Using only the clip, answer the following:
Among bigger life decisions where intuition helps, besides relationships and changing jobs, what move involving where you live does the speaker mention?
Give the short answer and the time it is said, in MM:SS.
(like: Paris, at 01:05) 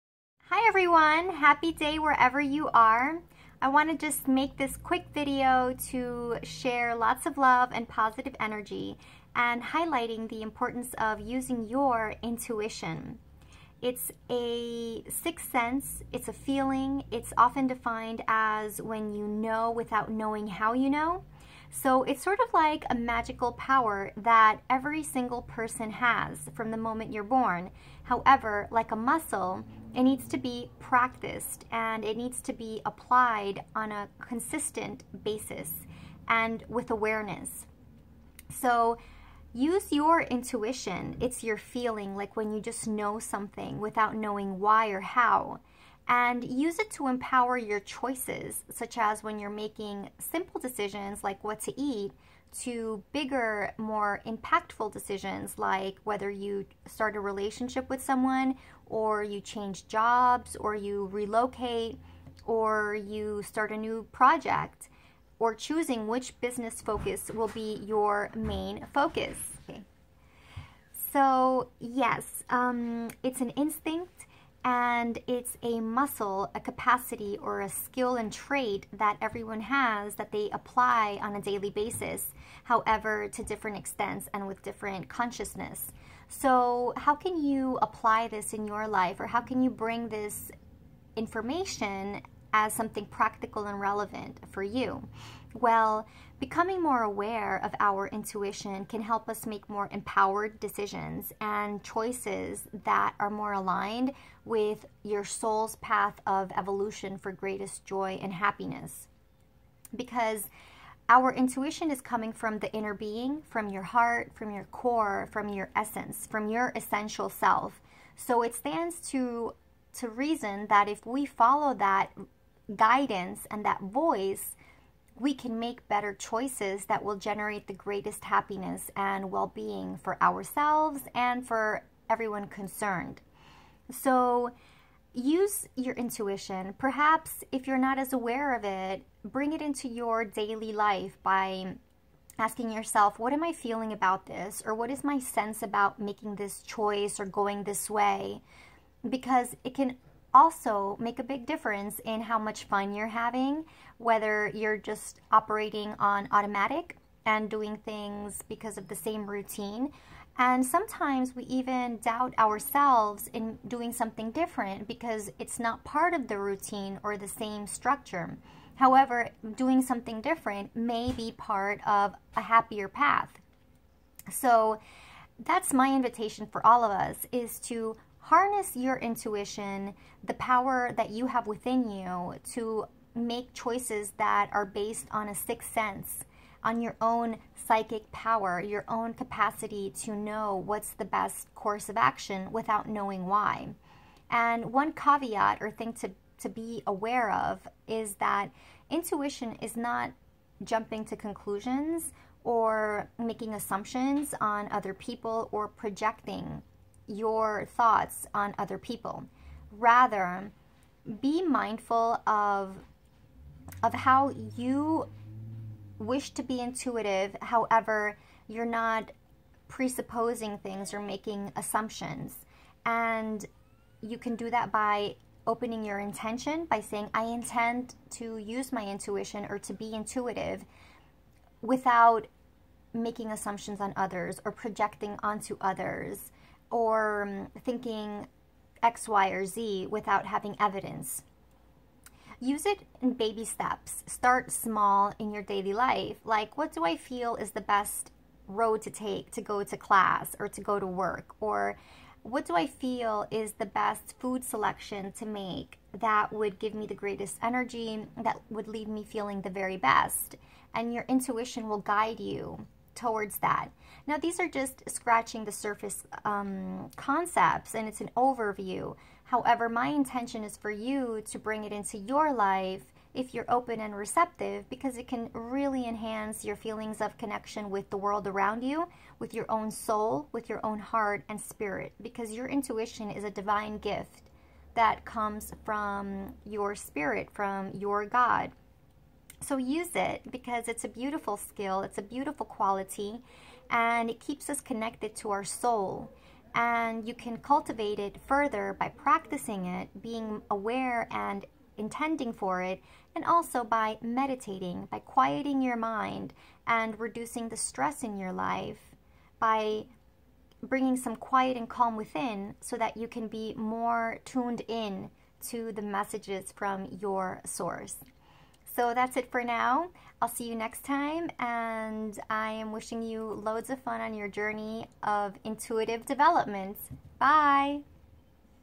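relocate, at 01:01.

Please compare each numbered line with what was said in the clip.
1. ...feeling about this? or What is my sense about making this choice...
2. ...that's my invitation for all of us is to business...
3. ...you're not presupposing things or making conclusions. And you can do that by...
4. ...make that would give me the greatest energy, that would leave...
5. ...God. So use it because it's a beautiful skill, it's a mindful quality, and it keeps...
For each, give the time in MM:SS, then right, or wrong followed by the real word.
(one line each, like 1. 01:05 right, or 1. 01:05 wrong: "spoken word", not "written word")
1. 02:23 right
2. 02:55 wrong: "harness", not "business"
3. 03:38 wrong: "assumptions", not "conclusions"
4. 04:15 right
5. 04:48 wrong: "beautiful", not "mindful".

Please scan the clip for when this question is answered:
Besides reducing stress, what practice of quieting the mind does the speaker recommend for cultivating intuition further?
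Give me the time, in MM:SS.
05:04.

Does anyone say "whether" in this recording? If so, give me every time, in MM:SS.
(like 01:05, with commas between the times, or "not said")
00:56, 02:33.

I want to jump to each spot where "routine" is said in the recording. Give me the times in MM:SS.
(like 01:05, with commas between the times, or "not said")
02:39, 02:46.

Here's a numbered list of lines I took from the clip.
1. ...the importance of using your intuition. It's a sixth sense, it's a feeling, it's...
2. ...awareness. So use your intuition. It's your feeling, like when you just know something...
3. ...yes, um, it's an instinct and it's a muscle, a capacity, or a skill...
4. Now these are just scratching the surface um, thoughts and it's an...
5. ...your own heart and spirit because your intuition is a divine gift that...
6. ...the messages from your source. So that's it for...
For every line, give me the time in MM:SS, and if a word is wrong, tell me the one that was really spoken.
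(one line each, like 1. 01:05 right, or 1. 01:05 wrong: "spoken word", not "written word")
1. 00:10 right
2. 00:36 right
3. 01:11 right
4. 04:24 wrong: "concepts", not "thoughts"
5. 04:40 right
6. 05:15 right.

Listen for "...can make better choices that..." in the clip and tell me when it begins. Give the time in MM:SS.
02:05.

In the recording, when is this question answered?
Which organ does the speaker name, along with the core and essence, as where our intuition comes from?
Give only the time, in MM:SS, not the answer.
01:53.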